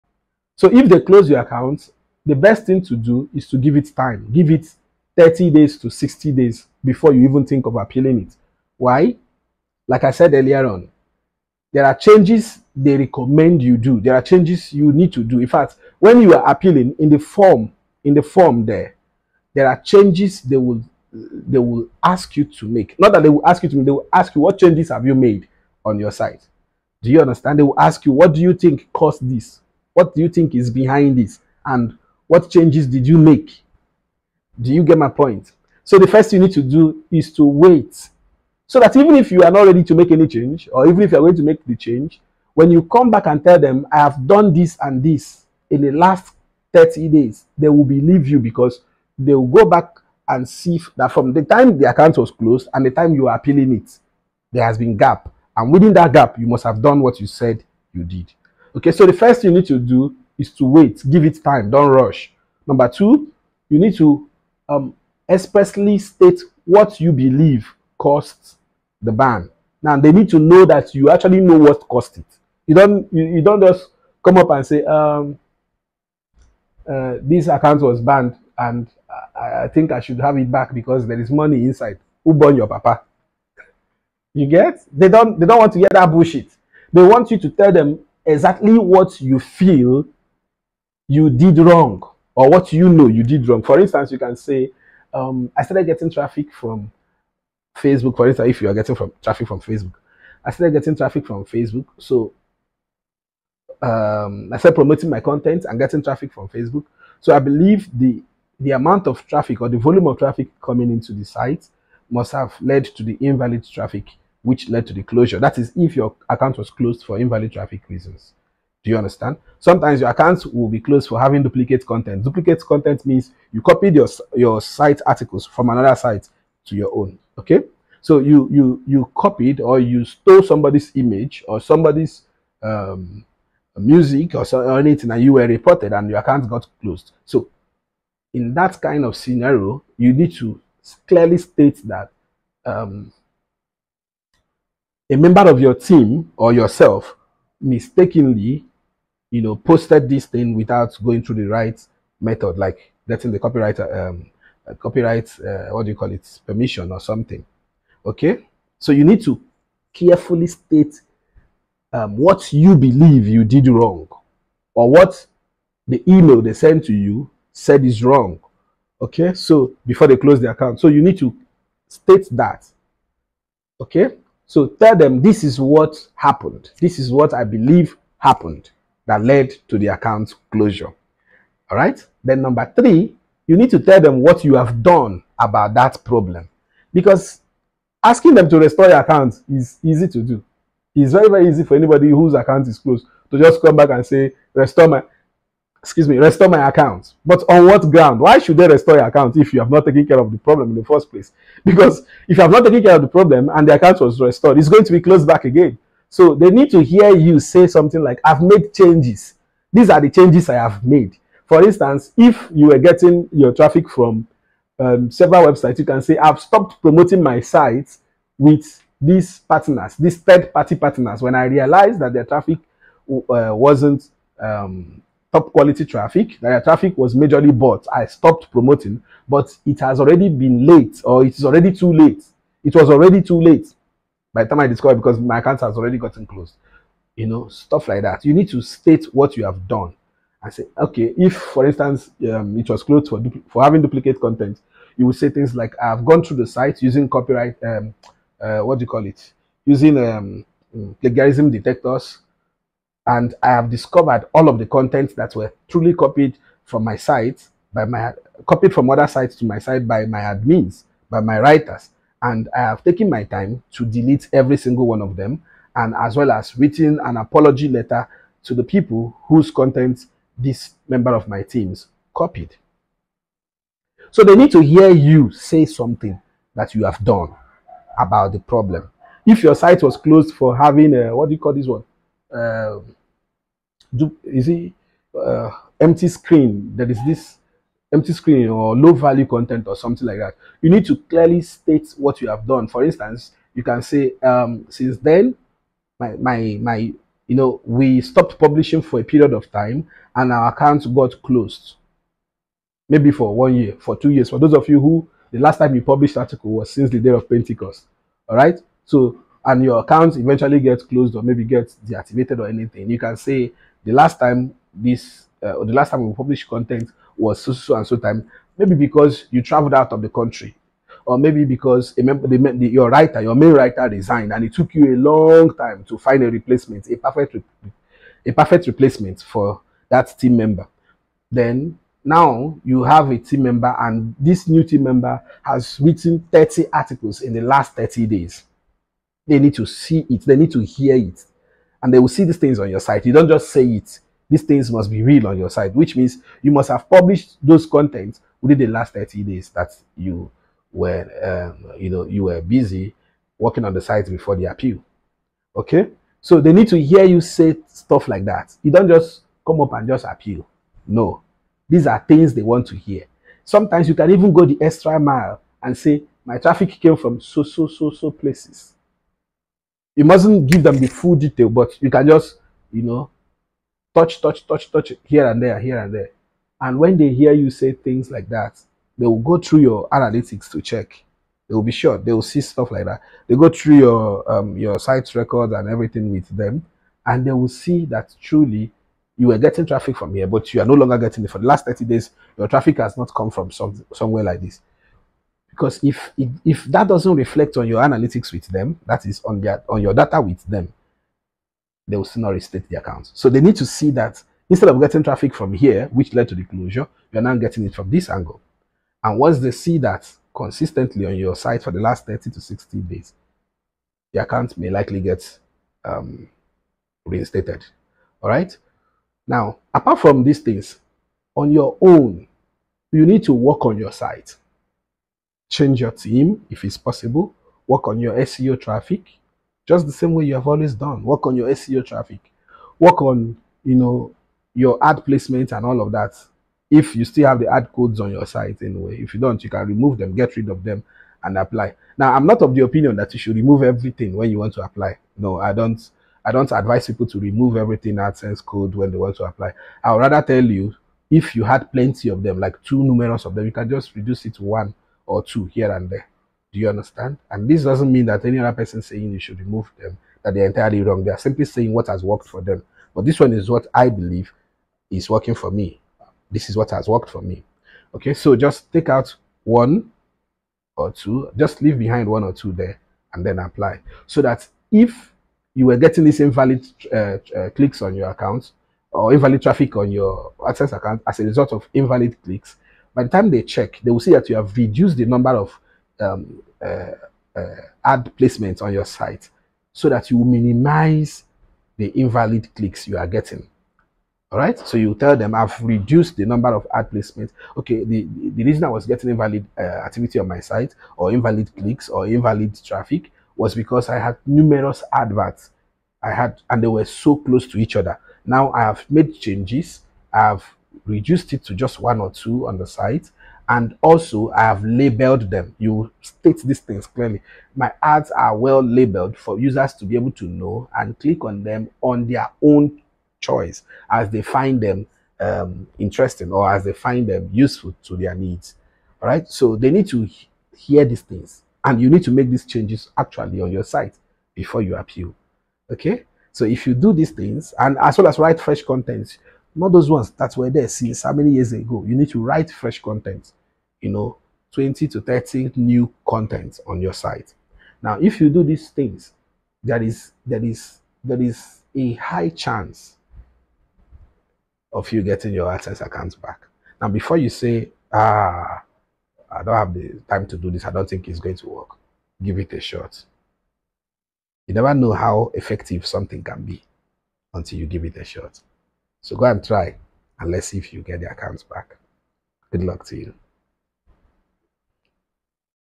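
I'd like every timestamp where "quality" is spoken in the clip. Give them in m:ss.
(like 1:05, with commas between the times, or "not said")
3:45.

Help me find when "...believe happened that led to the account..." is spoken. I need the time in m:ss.
2:57.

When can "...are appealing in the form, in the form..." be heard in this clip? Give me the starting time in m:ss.
0:16.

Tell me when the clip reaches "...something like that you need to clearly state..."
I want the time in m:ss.
4:49.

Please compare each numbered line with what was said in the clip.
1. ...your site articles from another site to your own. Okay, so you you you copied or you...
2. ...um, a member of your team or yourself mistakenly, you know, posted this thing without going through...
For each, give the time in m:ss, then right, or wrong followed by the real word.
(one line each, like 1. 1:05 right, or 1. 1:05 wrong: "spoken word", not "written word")
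1. 2:04 right
2. 2:22 right.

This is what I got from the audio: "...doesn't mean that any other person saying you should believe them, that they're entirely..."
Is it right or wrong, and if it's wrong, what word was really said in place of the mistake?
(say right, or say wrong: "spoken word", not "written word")
wrong: "remove", not "believe".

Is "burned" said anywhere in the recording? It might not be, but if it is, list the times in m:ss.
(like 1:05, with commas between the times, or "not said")
1:22.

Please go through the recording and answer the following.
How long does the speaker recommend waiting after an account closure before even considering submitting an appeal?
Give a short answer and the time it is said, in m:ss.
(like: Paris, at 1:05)
30 to 60 days, at 0:05.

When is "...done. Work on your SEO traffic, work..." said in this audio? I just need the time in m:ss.
7:10.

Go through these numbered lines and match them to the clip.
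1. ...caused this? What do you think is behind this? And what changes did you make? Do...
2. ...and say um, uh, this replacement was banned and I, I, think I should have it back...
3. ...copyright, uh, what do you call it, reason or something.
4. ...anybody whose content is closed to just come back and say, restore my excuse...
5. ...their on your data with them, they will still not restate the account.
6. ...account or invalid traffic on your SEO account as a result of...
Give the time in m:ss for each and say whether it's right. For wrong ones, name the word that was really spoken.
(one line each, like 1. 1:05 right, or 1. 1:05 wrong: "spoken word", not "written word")
1. 0:28 right
2. 1:14 wrong: "account", not "replacement"
3. 2:34 wrong: "permission", not "reason"
4. 3:11 wrong: "account", not "content"
5. 6:39 right
6. 7:58 wrong: "AdSense", not "SEO".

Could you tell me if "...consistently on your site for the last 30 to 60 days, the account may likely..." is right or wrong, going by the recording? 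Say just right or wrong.
right.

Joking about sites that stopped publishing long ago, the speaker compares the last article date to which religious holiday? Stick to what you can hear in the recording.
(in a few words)
Pentecost.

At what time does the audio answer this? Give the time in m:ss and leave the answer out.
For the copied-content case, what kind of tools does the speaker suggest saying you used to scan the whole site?
4:10.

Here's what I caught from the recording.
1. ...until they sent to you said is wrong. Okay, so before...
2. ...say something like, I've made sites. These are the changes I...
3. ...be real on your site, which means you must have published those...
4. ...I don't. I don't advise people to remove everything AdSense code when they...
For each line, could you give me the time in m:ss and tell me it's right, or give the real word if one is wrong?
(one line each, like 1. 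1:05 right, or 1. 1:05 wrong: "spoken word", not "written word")
1. 2:46 wrong: "email", not "until"
2. 3:27 wrong: "changes", not "sites"
3. 5:44 right
4. 7:25 right.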